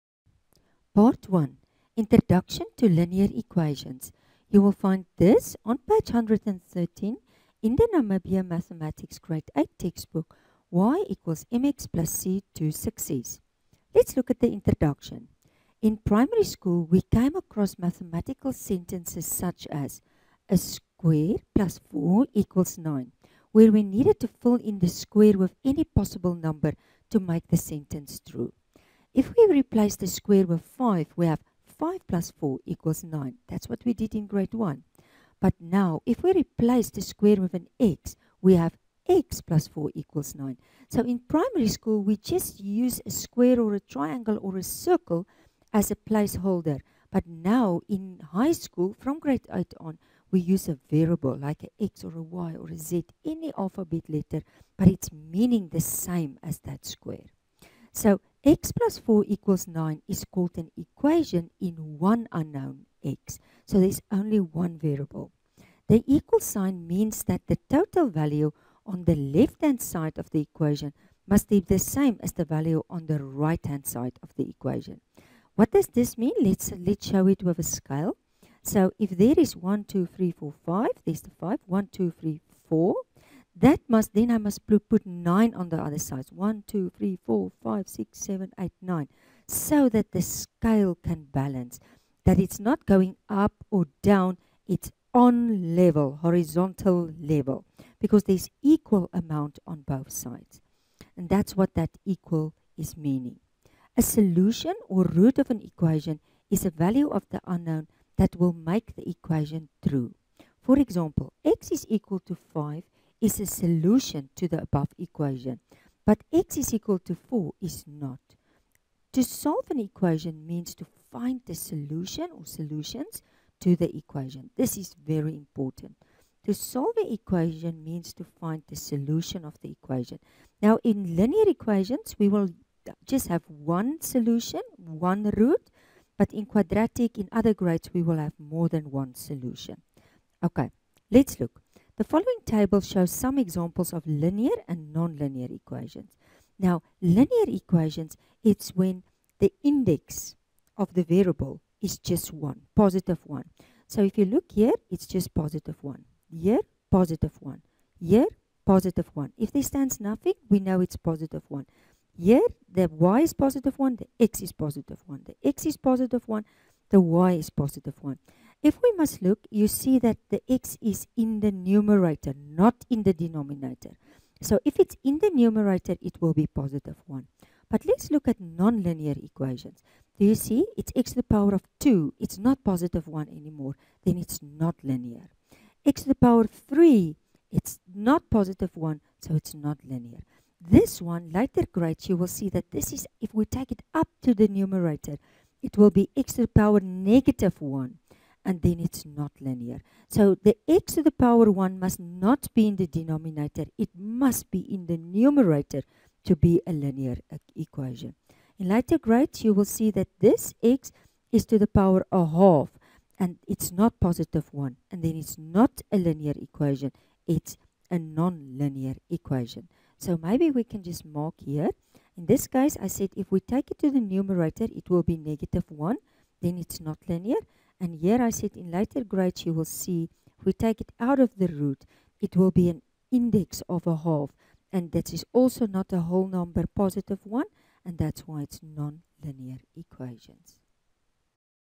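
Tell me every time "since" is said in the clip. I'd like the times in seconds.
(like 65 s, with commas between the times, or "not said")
not said.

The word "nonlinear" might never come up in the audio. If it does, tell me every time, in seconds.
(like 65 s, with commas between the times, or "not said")
144 s, 178 s.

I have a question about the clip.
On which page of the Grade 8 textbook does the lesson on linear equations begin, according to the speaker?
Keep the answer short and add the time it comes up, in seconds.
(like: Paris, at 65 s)
113, at 5 s.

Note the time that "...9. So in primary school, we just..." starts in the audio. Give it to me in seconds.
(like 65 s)
40 s.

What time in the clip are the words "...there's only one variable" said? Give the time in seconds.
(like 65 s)
63 s.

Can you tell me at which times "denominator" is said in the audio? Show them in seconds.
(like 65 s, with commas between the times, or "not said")
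173 s, 202 s.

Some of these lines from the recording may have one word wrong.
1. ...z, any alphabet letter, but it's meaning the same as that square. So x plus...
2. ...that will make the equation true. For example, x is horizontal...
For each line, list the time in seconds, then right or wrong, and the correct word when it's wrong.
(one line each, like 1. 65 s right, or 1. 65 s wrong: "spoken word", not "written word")
1. 52 s right
2. 108 s wrong: "equal", not "horizontal".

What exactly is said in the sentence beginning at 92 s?
That it's not going up or down.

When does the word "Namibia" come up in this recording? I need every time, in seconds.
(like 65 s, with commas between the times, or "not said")
7 s.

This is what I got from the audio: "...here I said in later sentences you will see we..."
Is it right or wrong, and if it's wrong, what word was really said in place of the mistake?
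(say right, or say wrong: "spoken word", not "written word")
wrong: "grades", not "sentences".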